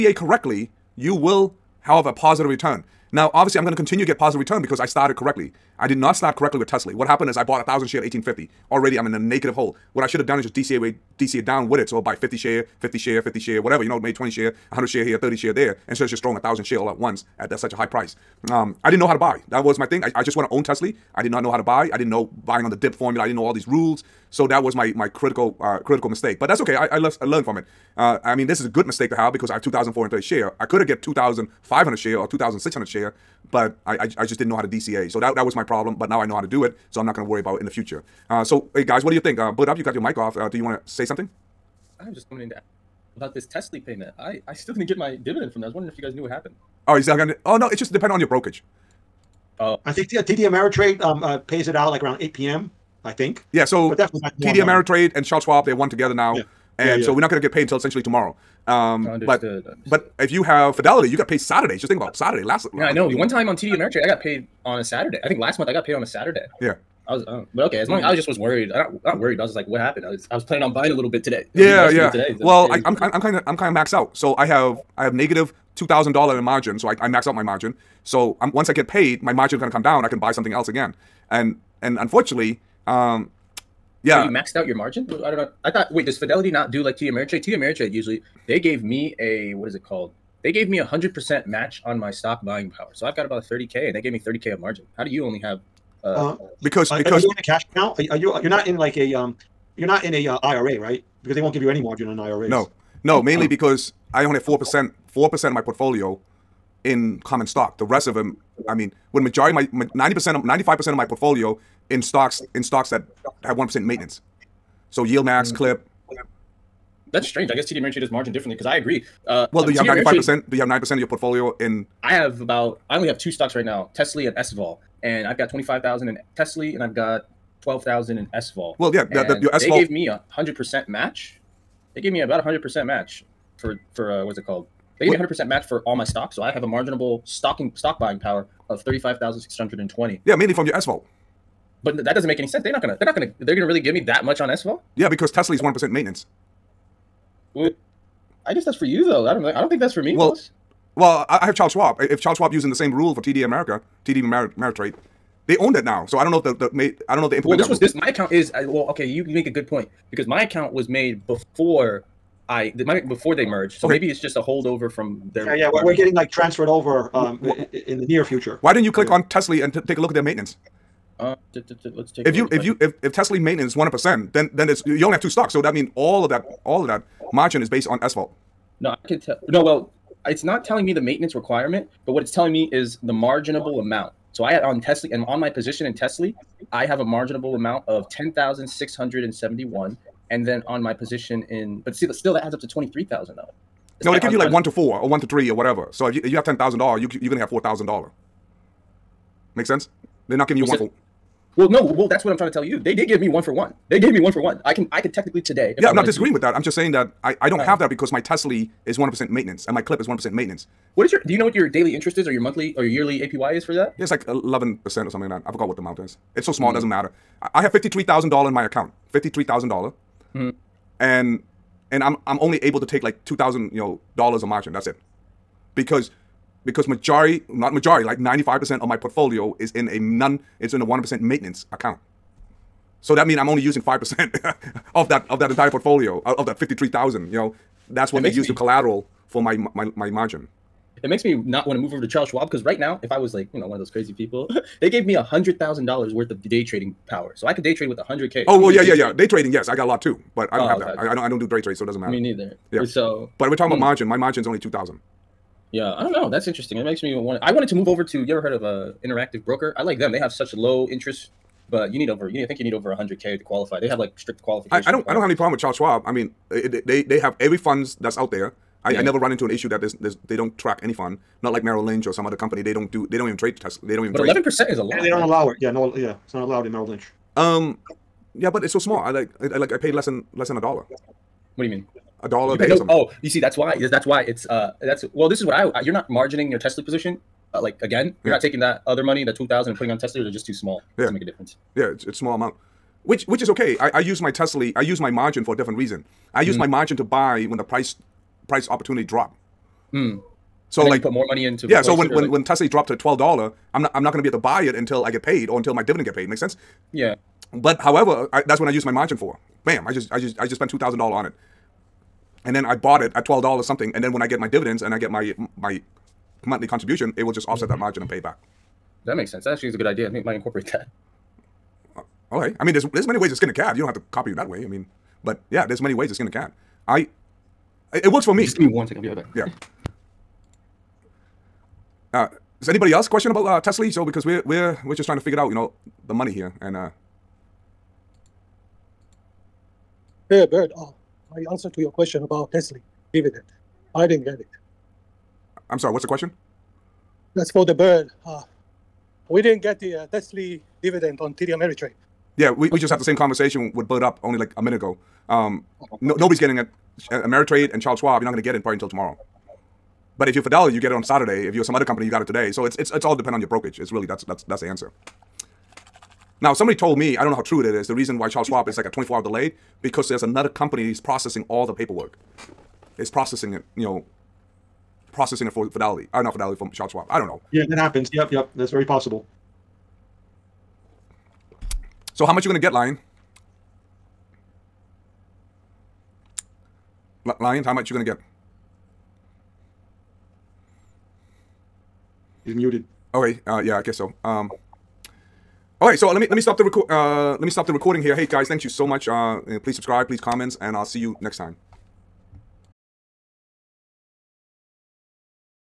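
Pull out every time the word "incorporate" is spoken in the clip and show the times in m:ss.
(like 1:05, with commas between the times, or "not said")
5:20.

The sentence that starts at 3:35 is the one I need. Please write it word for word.
I forgot what the amount is.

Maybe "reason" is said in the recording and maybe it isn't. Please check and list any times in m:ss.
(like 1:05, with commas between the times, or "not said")
4:55, 6:07.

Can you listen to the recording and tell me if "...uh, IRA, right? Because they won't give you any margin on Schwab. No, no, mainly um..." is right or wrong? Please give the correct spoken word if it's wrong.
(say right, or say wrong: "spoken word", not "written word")
wrong: "IRA", not "Schwab".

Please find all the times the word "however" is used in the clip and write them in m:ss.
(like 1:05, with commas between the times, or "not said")
5:07.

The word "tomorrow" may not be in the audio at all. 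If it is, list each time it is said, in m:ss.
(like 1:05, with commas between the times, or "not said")
0:58, 5:58.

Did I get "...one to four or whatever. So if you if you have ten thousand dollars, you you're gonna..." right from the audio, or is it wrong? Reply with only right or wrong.
wrong.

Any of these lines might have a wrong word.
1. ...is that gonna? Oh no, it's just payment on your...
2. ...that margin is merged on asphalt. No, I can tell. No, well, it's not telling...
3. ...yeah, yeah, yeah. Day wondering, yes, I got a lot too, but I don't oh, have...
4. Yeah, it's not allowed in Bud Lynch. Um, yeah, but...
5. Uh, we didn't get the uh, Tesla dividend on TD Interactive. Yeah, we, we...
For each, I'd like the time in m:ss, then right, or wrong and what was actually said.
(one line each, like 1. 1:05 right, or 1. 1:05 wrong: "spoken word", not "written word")
1. 0:46 wrong: "dependent", not "payment"
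2. 2:56 wrong: "based", not "merged"
3. 4:08 wrong: "trading", not "wondering"
4. 4:35 wrong: "Merrill", not "Bud"
5. 5:48 wrong: "Ameritrade", not "Interactive".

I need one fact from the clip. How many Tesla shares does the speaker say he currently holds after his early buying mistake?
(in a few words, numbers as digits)
2430.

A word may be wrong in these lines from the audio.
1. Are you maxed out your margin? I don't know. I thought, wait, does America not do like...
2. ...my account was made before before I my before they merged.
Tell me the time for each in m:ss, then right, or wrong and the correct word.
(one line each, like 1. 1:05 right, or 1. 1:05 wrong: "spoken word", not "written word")
1. 1:24 wrong: "Fidelity", not "America"
2. 2:40 right.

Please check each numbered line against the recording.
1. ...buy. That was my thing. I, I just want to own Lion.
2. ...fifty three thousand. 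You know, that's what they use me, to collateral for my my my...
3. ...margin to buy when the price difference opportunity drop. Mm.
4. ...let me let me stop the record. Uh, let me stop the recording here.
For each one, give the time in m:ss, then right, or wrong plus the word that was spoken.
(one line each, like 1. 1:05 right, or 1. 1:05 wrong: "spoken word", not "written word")
1. 0:19 wrong: "Tesla", not "Lion"
2. 3:56 right
3. 4:56 wrong: "price", not "difference"
4. 6:36 right.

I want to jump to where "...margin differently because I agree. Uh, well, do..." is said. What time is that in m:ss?
1:58.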